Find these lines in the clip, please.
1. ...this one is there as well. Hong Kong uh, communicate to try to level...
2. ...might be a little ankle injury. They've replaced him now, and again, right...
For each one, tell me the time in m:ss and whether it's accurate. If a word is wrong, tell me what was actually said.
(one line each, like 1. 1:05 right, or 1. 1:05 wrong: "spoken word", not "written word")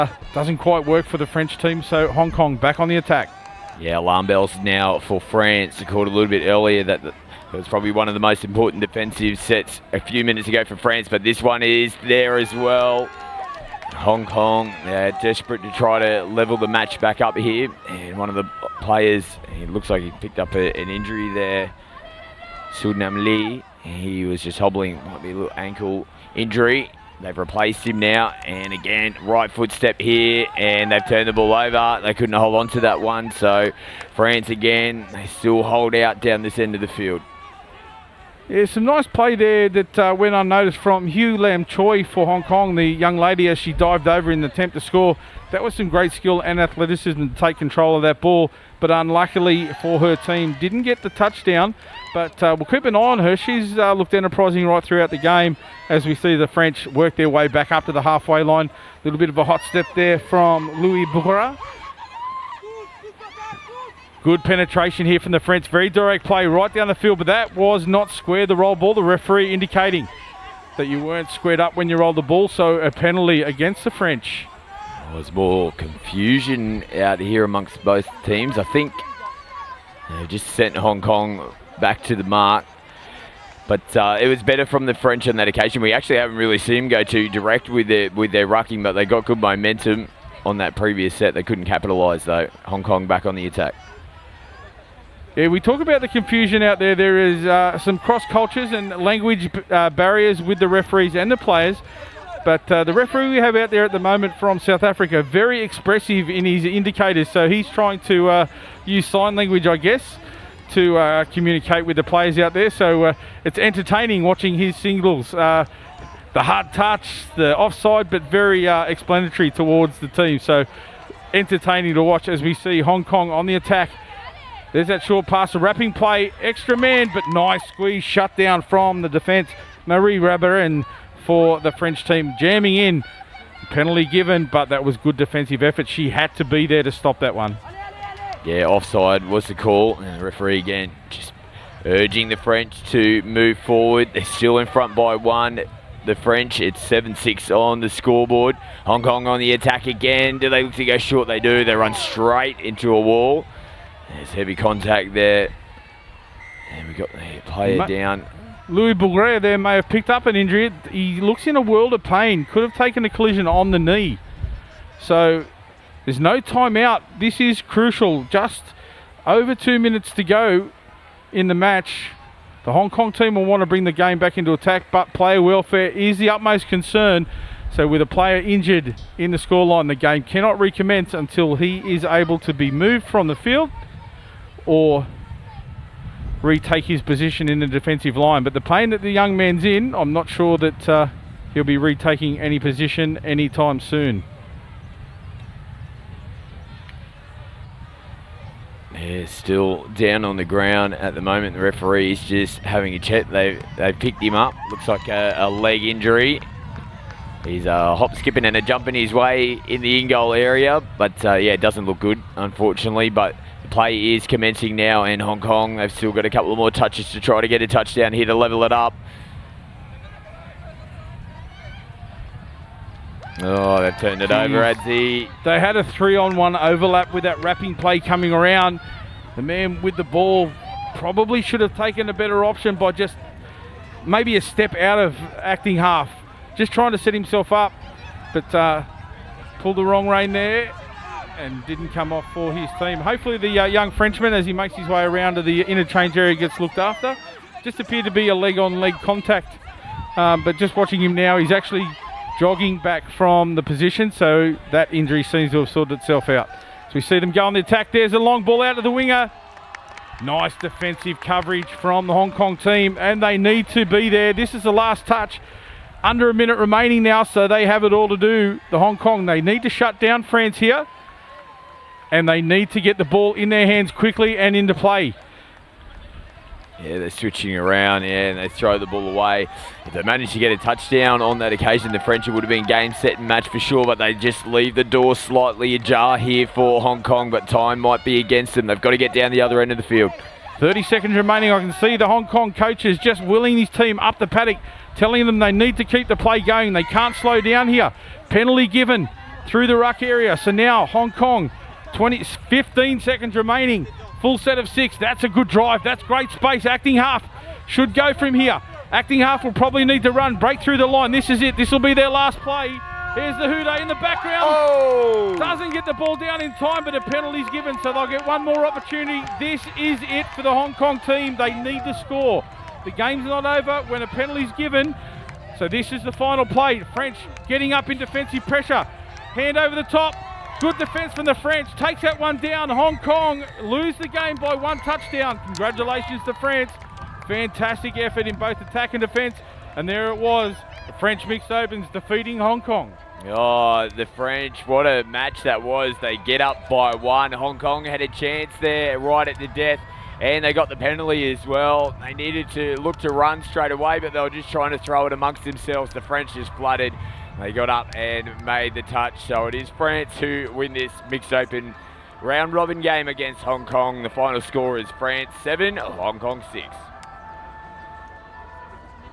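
1. 0:11 wrong: "desperate", not "communicate"
2. 0:25 right.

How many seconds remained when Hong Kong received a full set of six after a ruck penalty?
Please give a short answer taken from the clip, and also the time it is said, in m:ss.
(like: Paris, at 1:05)
15, at 5:02.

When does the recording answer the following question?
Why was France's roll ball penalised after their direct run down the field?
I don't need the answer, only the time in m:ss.
1:07.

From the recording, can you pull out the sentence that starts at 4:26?
Under a minute remaining now, so they have it all to do.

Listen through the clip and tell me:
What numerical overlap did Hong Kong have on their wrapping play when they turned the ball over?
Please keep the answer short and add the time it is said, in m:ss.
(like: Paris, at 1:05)
Three-on-one, at 3:45.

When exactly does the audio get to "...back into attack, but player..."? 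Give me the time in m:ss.
2:54.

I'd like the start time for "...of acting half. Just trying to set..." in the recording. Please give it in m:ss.
3:54.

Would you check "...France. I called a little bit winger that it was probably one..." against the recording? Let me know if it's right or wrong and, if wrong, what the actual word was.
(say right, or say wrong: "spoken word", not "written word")
wrong: "earlier", not "winger".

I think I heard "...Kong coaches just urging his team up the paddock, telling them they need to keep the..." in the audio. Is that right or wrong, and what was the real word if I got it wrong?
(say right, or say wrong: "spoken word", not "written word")
wrong: "willing", not "urging".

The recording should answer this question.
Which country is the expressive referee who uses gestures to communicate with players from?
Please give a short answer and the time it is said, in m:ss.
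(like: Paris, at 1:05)
South Africa, at 1:44.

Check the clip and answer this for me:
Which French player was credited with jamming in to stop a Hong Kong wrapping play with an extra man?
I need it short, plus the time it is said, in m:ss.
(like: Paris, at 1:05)
Marie Rabarin, at 2:09.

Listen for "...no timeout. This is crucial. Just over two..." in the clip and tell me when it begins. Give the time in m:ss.
2:46.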